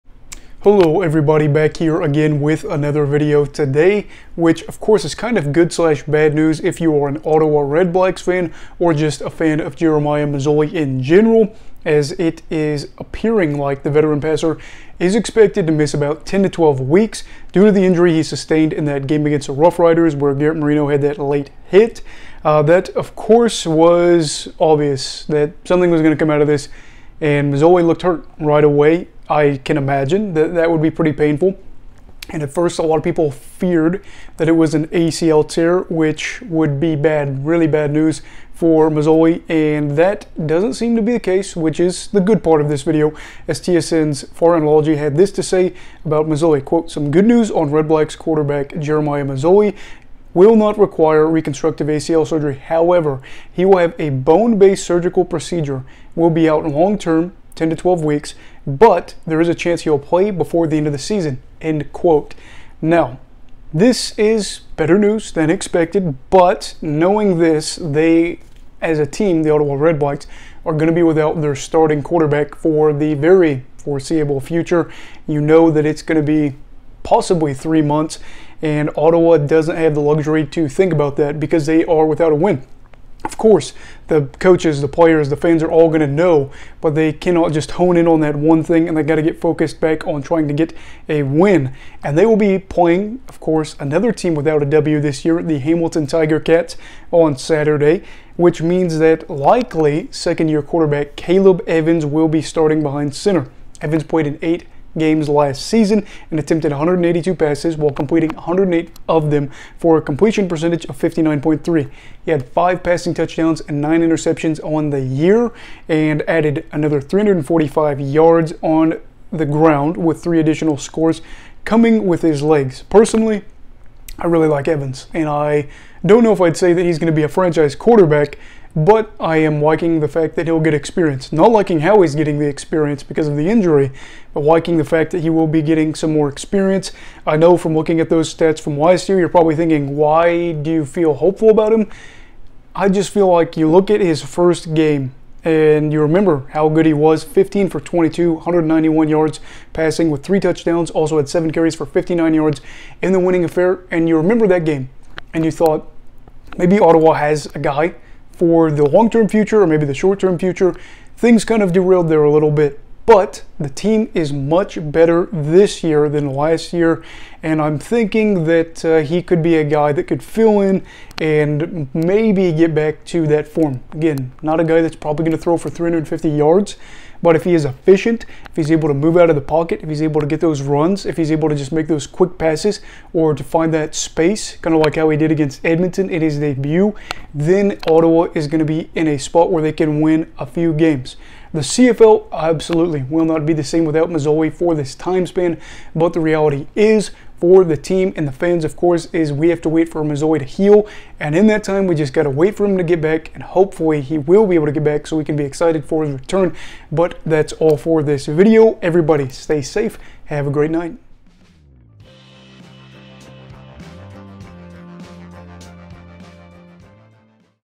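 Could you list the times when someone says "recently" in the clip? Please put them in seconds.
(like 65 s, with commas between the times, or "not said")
not said.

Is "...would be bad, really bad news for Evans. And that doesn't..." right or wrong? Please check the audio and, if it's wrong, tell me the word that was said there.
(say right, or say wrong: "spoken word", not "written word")
wrong: "Masoli", not "Evans".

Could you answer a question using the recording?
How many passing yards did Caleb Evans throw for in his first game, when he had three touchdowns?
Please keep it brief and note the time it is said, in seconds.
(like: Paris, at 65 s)
191, at 148 s.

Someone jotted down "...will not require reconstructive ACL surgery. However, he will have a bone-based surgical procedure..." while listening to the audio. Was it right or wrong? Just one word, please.
right.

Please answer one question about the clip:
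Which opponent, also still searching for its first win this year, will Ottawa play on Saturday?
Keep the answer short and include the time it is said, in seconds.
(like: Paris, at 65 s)
Hamilton Tiger Cats, at 95 s.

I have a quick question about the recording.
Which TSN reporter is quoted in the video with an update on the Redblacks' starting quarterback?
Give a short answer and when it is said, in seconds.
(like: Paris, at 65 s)
Farhan Lalji, at 44 s.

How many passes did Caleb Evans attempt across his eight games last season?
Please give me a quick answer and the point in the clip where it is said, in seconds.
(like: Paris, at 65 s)
182, at 106 s.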